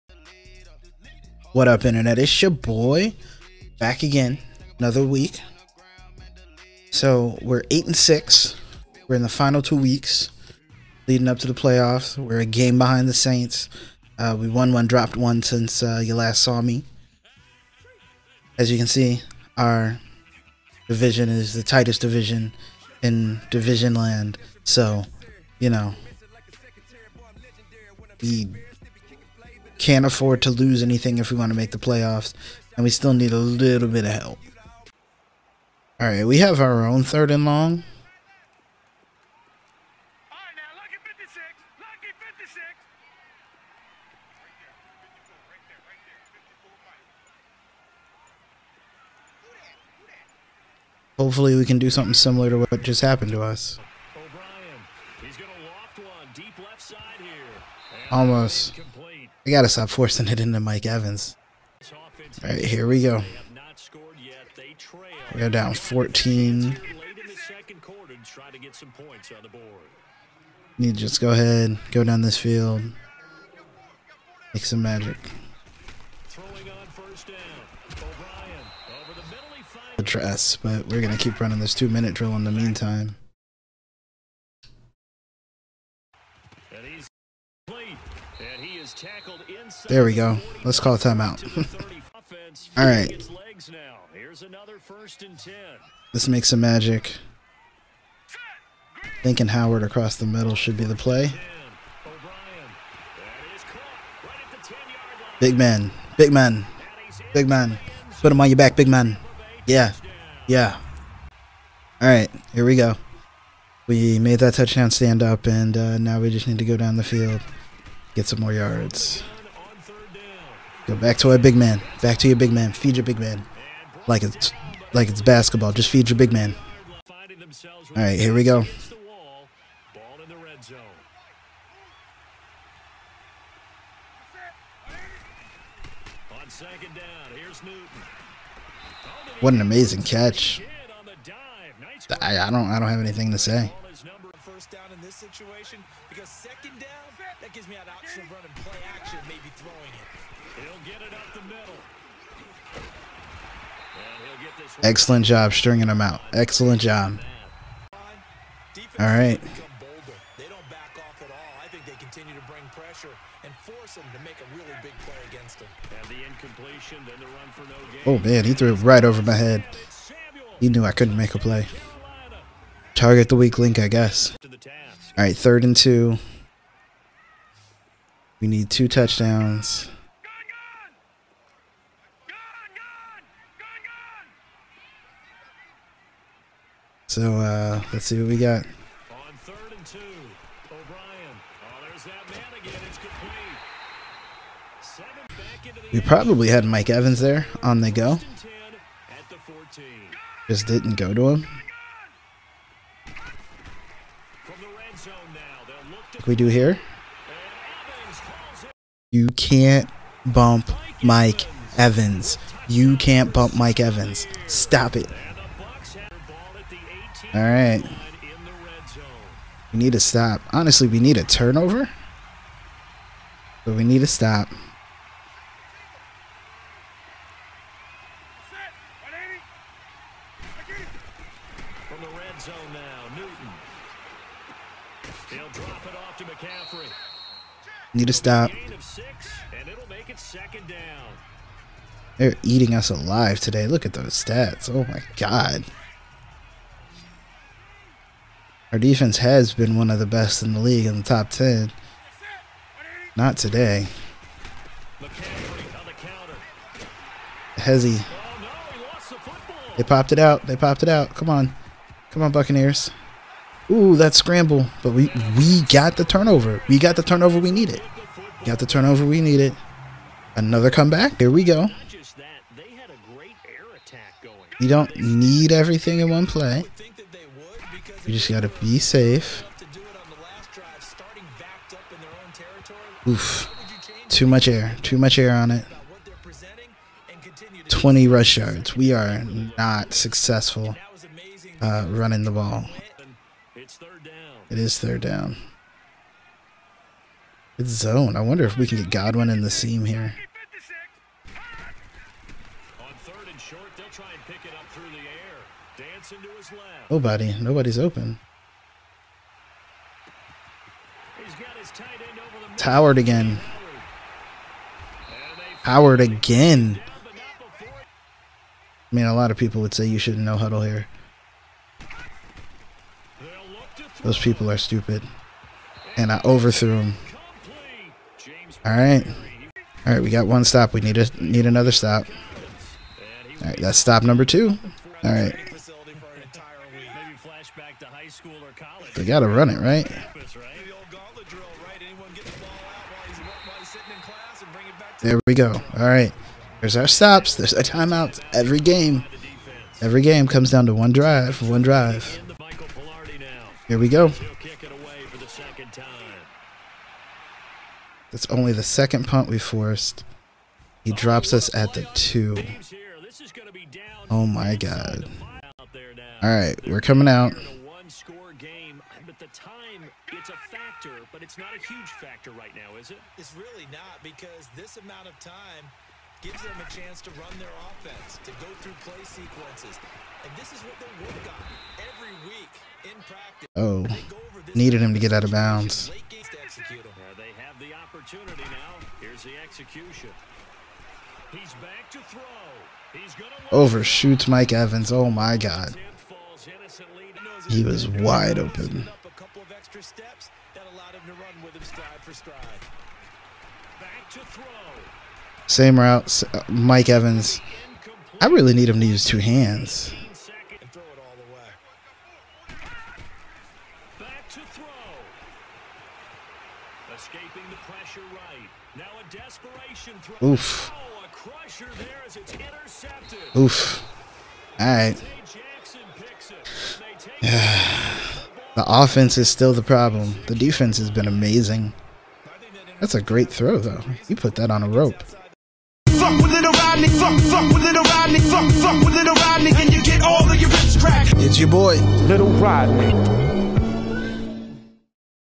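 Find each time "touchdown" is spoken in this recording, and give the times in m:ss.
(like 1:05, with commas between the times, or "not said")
1:54, 2:58.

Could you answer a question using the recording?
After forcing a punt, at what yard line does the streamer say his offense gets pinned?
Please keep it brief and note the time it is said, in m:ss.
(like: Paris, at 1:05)
2, at 6:01.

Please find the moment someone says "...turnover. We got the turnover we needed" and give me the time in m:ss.
4:26.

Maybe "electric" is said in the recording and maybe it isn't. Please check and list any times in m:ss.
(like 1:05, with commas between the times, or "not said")
not said.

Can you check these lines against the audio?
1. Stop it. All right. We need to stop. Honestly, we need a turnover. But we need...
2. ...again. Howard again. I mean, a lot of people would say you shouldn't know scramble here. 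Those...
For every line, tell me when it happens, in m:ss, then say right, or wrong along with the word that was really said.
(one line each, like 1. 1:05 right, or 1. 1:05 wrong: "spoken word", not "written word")
1. 3:34 right
2. 5:12 wrong: "huddle", not "scramble".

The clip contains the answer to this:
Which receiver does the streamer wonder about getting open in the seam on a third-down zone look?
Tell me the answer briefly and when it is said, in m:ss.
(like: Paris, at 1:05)
Godwin, at 4:58.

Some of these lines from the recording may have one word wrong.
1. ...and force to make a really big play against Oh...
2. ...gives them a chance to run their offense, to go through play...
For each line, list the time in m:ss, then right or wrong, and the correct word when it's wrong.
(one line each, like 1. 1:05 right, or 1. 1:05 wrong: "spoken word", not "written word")
1. 2:43 right
2. 6:16 right.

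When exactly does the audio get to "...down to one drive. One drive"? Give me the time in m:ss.
5:50.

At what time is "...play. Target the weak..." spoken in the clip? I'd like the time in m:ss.
2:51.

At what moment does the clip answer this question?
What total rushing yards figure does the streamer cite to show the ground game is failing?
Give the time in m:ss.
4:47.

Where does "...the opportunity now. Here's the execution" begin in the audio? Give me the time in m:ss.
6:27.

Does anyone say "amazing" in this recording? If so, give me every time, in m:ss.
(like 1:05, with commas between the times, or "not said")
2:19, 7:11.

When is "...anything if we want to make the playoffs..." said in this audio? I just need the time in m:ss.
0:30.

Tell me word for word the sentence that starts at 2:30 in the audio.
He'll get it up the middle.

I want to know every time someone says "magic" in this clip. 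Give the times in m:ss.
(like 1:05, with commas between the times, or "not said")
1:14, 1:36.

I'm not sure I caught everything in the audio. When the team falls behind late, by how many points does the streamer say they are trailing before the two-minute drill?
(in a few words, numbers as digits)
14.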